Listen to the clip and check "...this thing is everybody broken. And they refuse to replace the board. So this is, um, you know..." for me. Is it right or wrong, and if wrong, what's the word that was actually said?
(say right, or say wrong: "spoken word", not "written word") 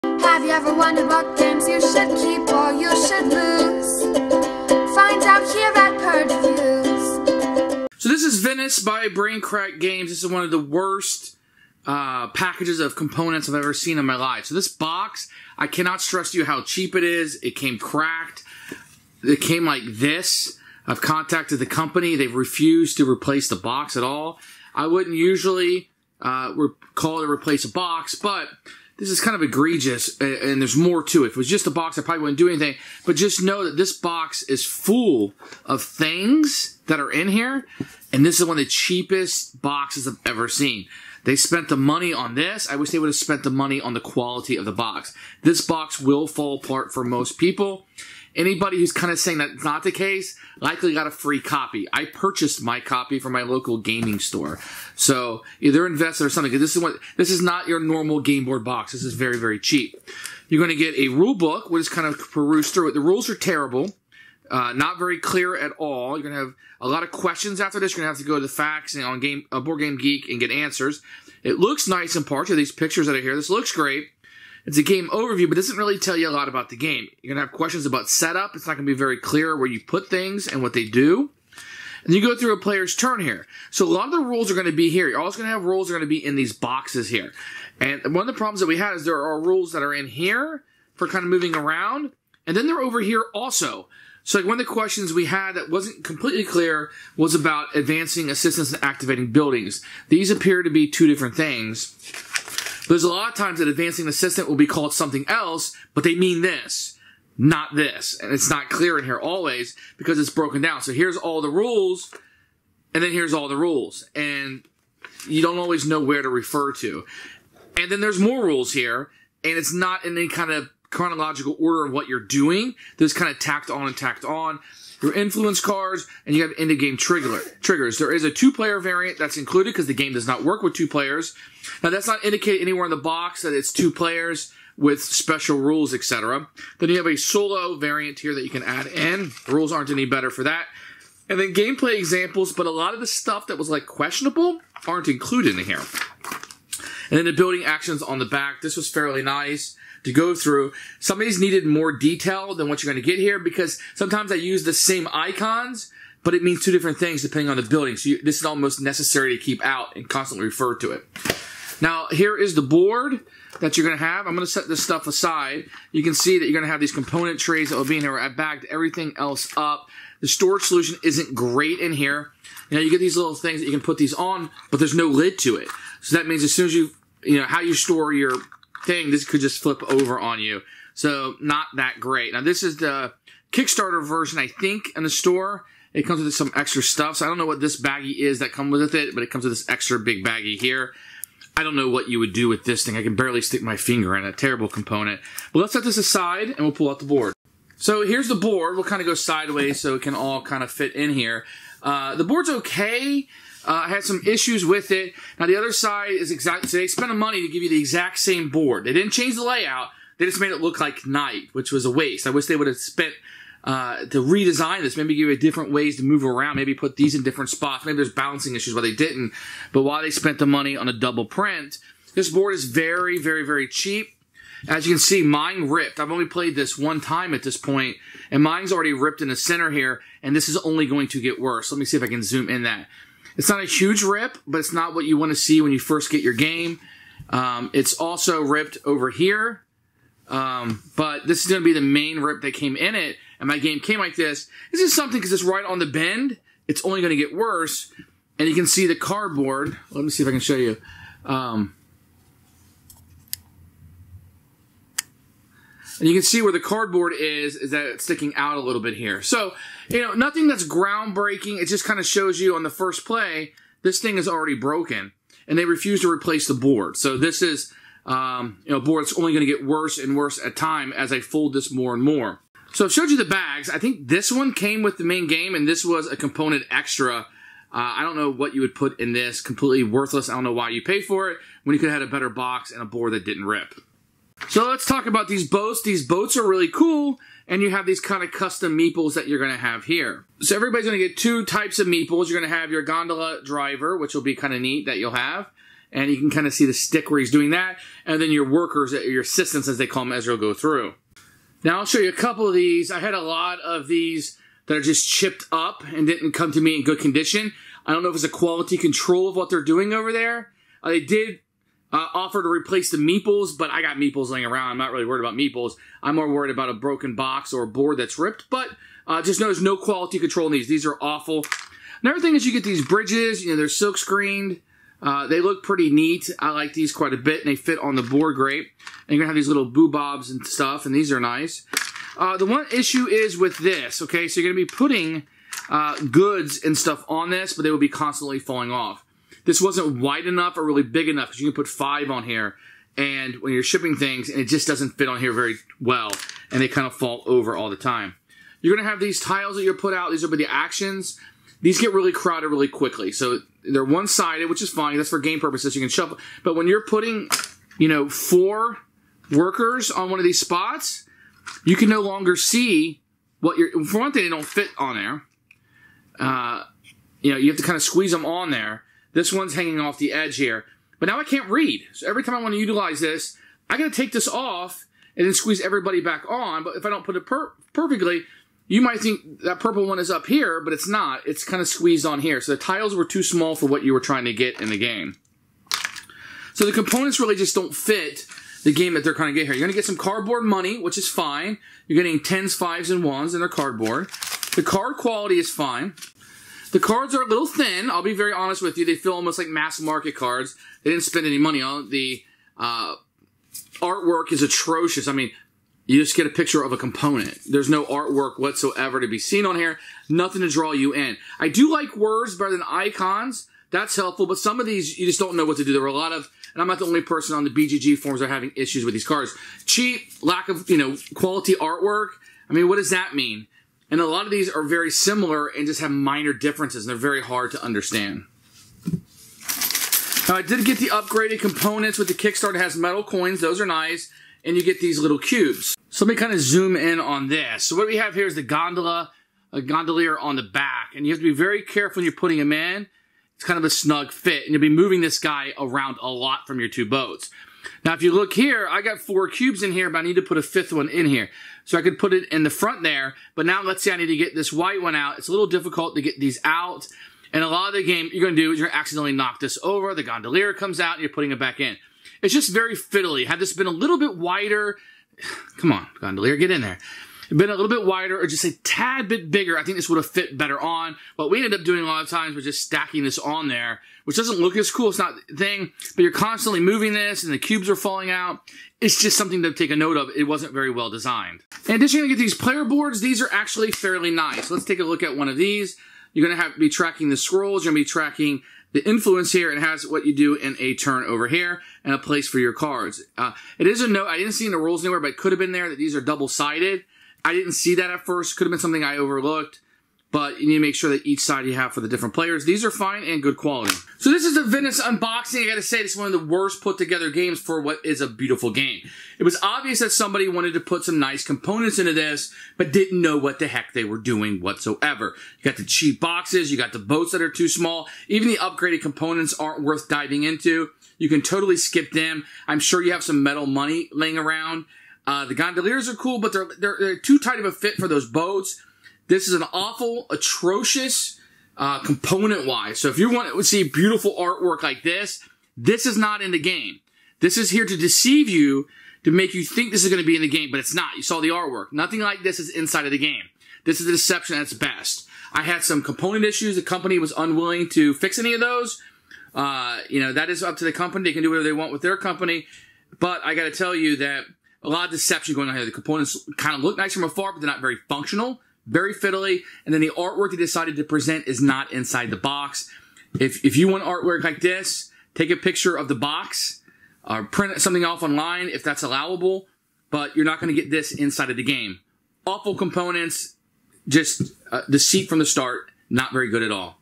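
wrong: "already", not "everybody".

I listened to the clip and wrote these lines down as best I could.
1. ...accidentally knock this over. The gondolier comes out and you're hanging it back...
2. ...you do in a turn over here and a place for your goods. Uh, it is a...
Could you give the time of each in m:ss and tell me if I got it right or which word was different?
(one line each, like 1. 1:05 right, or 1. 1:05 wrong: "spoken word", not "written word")
1. 7:38 wrong: "putting", not "hanging"
2. 8:10 wrong: "cards", not "goods".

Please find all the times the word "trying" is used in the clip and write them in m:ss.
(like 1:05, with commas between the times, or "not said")
6:23, 6:29.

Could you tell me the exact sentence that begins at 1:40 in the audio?
These appear to be two different things.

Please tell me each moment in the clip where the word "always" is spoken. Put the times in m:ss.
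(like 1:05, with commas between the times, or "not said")
1:25, 1:49, 1:55.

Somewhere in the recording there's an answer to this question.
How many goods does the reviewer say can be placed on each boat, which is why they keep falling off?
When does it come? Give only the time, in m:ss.
5:41.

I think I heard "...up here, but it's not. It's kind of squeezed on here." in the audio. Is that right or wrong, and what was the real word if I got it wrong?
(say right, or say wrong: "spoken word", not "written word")
right.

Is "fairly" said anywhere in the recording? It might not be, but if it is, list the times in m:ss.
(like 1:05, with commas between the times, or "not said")
2:28, 8:03.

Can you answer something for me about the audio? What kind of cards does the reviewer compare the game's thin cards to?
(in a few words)
mass market cards.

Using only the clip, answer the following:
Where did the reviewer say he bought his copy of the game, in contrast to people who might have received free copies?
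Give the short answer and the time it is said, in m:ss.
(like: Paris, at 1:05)
local gaming store, at 0:53.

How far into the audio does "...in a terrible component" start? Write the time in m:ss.
3:14.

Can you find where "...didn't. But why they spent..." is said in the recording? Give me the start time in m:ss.
3:38.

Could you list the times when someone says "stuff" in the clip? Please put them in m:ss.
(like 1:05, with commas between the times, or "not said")
2:23, 2:44, 3:06, 5:30, 5:36.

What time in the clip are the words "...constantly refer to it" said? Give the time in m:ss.
2:40.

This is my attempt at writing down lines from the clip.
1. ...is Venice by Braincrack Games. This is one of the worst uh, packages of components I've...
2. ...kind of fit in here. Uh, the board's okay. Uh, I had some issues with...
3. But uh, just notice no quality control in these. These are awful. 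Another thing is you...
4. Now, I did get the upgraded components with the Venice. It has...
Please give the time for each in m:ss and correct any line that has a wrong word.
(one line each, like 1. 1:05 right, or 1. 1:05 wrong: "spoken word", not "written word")
1. 0:08 right
2. 3:20 right
3. 5:18 right
4. 7:10 wrong: "Kickstarter", not "Venice".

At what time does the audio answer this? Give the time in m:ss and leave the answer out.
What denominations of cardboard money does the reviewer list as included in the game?
6:32.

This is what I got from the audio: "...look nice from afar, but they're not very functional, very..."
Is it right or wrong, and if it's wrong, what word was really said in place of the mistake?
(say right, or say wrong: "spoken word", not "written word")
right.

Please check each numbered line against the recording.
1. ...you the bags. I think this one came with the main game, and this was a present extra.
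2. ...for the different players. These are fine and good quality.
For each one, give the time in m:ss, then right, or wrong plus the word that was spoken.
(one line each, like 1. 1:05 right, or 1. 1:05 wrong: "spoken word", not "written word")
1. 4:33 wrong: "component", not "present"
2. 8:21 right.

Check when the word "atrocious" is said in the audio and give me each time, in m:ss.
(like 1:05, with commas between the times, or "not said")
6:44, 8:50.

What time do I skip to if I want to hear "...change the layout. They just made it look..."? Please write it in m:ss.
3:29.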